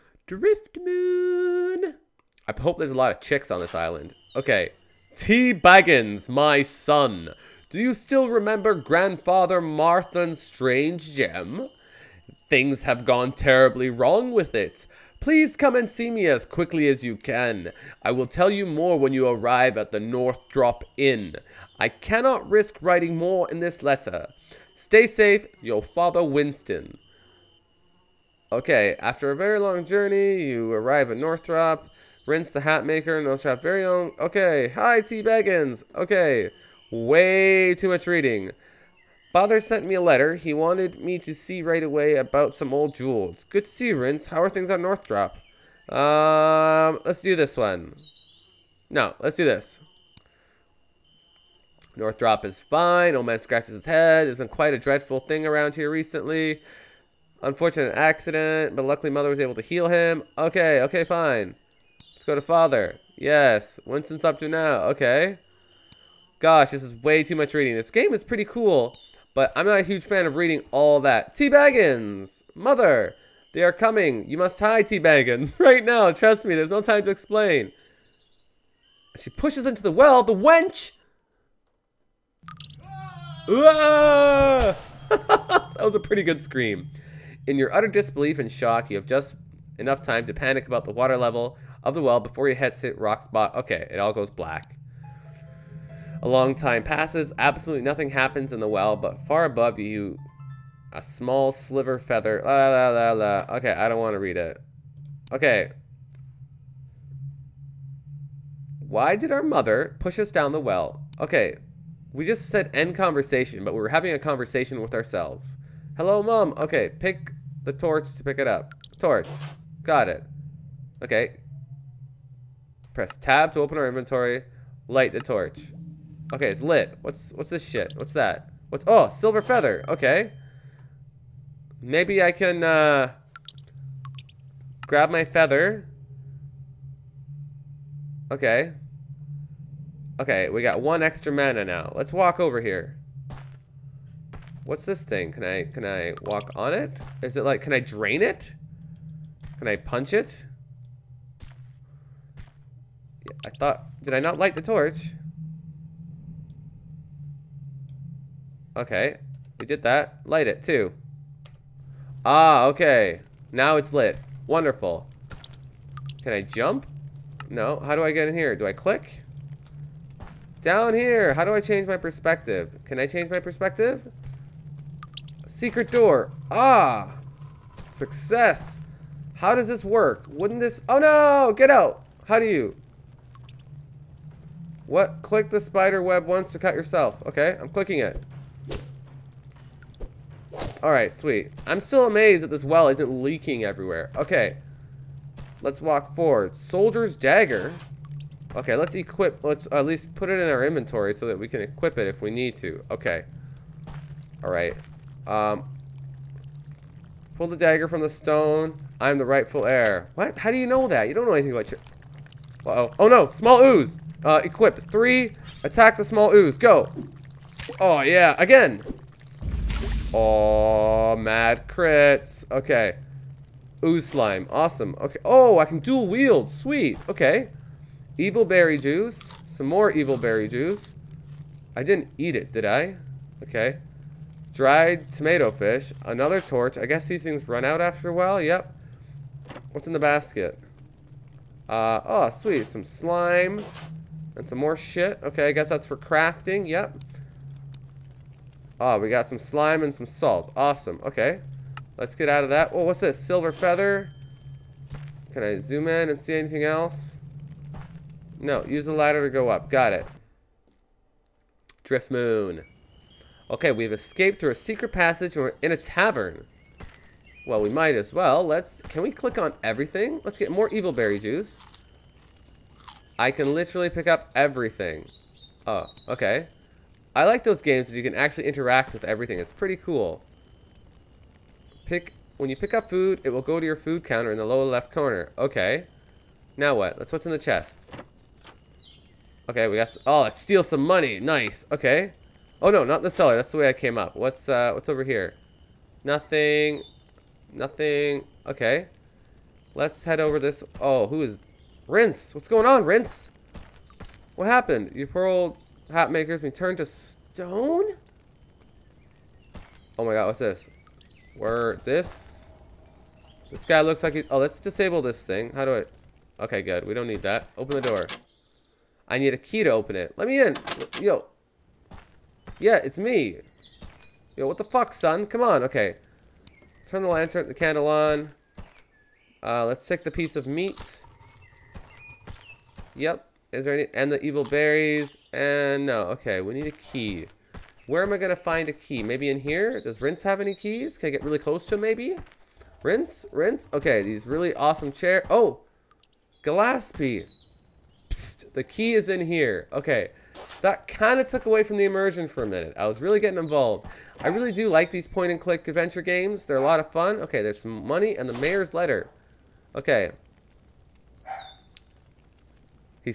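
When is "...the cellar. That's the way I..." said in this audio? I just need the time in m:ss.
4:53.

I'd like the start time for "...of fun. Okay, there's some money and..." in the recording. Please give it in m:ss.
5:56.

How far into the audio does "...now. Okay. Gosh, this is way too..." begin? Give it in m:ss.
1:04.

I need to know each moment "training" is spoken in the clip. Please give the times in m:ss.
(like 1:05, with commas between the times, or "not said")
not said.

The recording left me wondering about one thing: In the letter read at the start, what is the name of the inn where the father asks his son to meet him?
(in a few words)
North Drop Inn.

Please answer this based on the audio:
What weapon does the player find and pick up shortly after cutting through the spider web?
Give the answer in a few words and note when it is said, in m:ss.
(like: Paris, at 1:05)
Soldier's dagger, at 3:16.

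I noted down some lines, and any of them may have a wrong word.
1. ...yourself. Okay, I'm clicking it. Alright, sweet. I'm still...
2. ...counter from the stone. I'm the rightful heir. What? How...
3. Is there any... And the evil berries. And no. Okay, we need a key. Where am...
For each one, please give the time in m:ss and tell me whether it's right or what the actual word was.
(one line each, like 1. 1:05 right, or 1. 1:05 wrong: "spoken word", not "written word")
1. 3:06 right
2. 3:27 wrong: "dagger", not "counter"
3. 5:33 right.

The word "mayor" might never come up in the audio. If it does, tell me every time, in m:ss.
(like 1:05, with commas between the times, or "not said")
5:58.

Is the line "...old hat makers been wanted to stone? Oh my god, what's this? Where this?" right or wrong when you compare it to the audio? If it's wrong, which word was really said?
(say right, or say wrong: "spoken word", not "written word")
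wrong: "turned", not "wanted".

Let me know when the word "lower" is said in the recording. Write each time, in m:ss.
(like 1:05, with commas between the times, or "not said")
4:44.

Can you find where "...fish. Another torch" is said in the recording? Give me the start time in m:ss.
3:55.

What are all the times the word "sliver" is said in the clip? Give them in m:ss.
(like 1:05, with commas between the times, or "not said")
1:41.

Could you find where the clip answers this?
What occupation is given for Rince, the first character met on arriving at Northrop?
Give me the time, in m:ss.
0:32.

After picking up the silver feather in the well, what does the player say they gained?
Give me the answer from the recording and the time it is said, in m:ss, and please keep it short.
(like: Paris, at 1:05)
One extra mana, at 2:20.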